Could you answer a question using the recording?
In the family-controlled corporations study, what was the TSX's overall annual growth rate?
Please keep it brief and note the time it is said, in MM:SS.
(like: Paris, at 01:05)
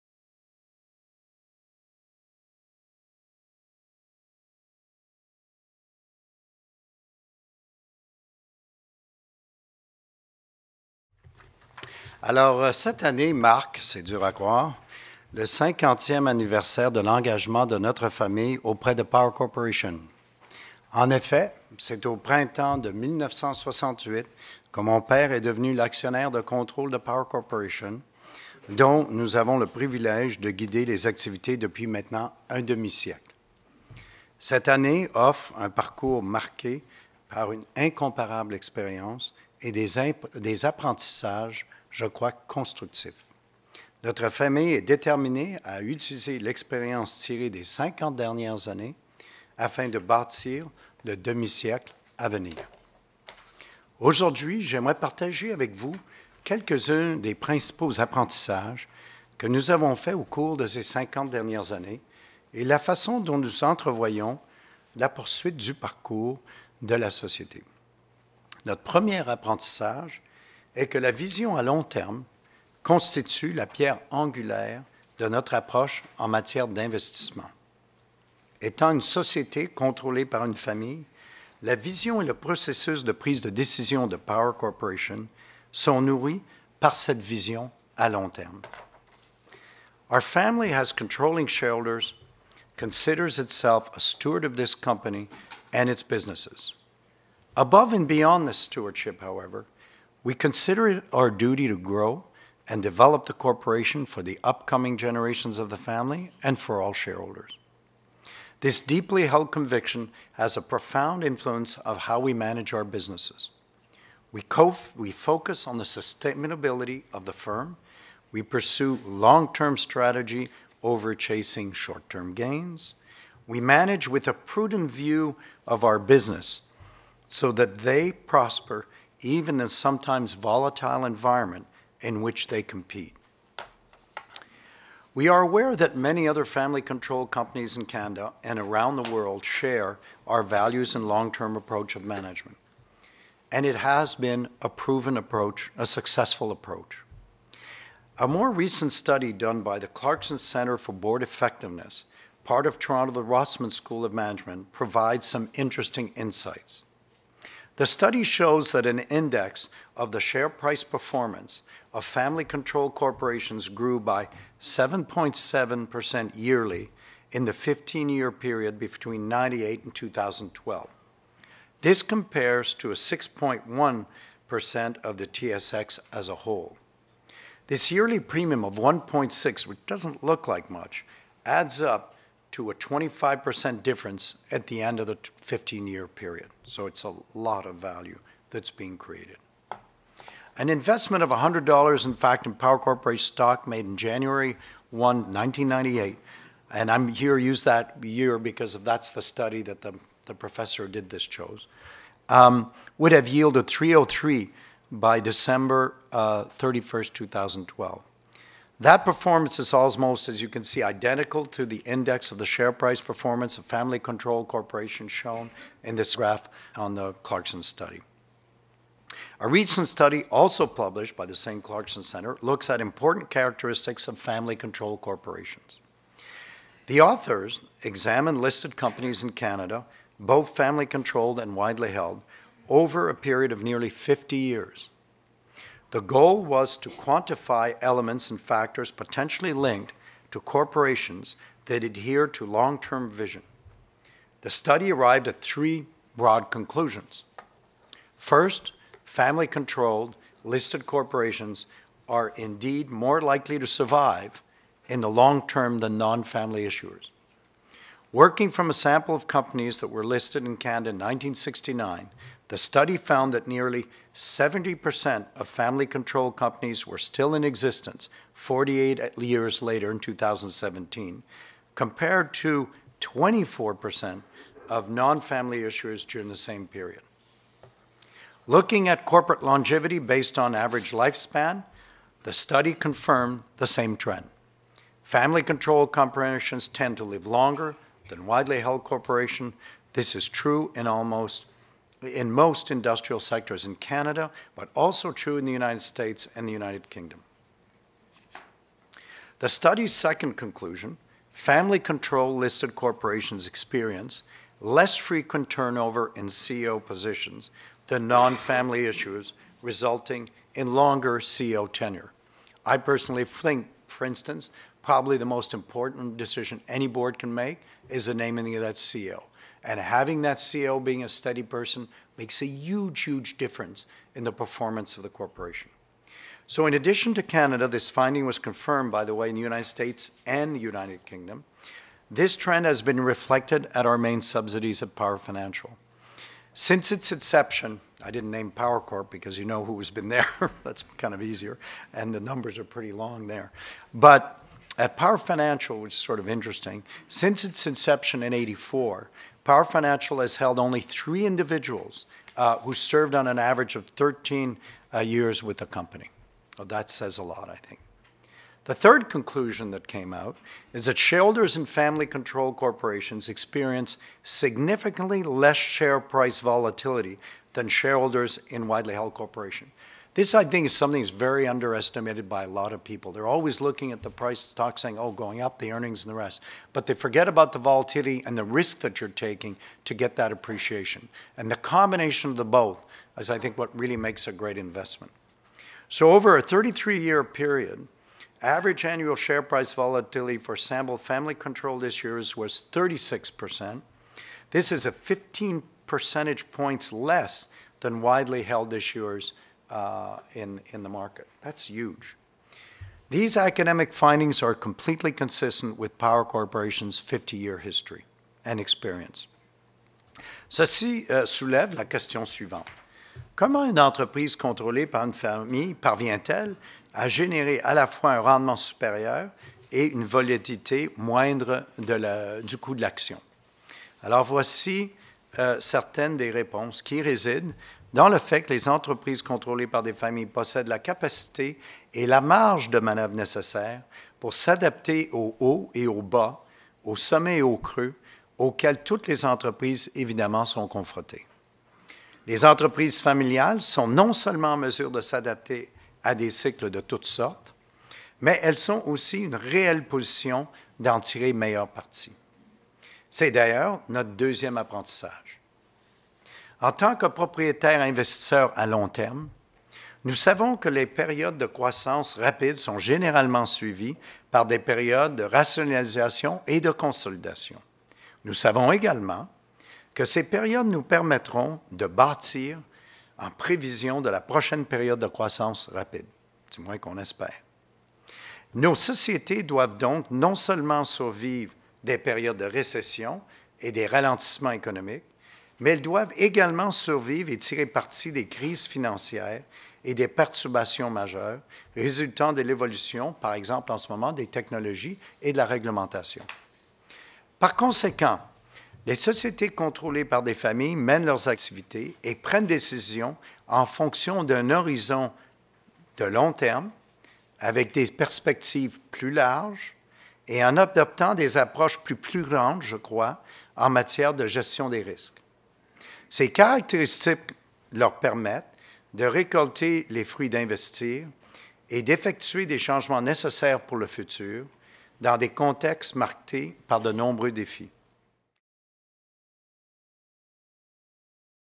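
6.1%, at 02:52.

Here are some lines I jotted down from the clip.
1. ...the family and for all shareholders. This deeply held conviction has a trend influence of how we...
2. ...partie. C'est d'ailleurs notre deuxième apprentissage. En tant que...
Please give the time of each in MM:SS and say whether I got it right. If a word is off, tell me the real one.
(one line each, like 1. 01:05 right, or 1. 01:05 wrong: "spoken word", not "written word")
1. 01:45 wrong: "profound", not "trend"
2. 07:31 right.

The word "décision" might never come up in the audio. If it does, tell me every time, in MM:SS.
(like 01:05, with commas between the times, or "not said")
01:23, 08:22.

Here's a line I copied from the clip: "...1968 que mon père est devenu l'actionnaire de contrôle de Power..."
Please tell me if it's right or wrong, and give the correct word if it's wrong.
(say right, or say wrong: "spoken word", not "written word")
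right.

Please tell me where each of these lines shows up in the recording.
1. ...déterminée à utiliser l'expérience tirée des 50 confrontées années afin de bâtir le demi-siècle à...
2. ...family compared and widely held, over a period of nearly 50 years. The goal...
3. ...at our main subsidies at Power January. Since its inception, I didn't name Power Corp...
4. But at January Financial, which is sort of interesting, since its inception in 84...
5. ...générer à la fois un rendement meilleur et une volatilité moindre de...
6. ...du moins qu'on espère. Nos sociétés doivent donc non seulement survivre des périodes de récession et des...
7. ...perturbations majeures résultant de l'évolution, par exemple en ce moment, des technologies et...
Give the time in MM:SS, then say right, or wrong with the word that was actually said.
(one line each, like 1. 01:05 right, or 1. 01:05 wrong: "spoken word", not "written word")
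1. 00:44 wrong: "dernières", not "confrontées"
2. 03:50 wrong: "controlled", not "compared"
3. 05:33 wrong: "Financial", not "January"
4. 05:43 wrong: "Power", not "January"
5. 06:57 wrong: "supérieur", not "meilleur"
6. 07:56 right
7. 08:10 right.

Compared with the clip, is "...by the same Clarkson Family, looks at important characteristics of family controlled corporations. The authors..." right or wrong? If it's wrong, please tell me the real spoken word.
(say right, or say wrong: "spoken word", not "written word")
wrong: "Center", not "Family".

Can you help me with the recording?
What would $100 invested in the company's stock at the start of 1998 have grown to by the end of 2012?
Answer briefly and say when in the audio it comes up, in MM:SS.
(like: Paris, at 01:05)
303, at 03:23.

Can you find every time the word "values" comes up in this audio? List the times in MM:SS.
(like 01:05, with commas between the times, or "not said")
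02:20, 03:07.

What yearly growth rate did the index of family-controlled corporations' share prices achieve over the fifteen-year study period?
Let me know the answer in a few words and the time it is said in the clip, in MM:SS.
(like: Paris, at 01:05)
7.7%, at 02:44.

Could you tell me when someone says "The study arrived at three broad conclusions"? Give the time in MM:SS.
04:04.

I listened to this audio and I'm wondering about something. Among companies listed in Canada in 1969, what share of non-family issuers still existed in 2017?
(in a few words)
24%.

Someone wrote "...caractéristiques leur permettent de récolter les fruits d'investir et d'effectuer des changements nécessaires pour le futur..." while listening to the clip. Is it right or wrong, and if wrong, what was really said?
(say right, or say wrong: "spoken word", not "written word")
right.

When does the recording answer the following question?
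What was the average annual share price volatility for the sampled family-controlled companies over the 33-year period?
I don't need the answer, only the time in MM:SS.
06:32.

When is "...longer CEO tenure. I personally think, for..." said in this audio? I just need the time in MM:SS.
05:10.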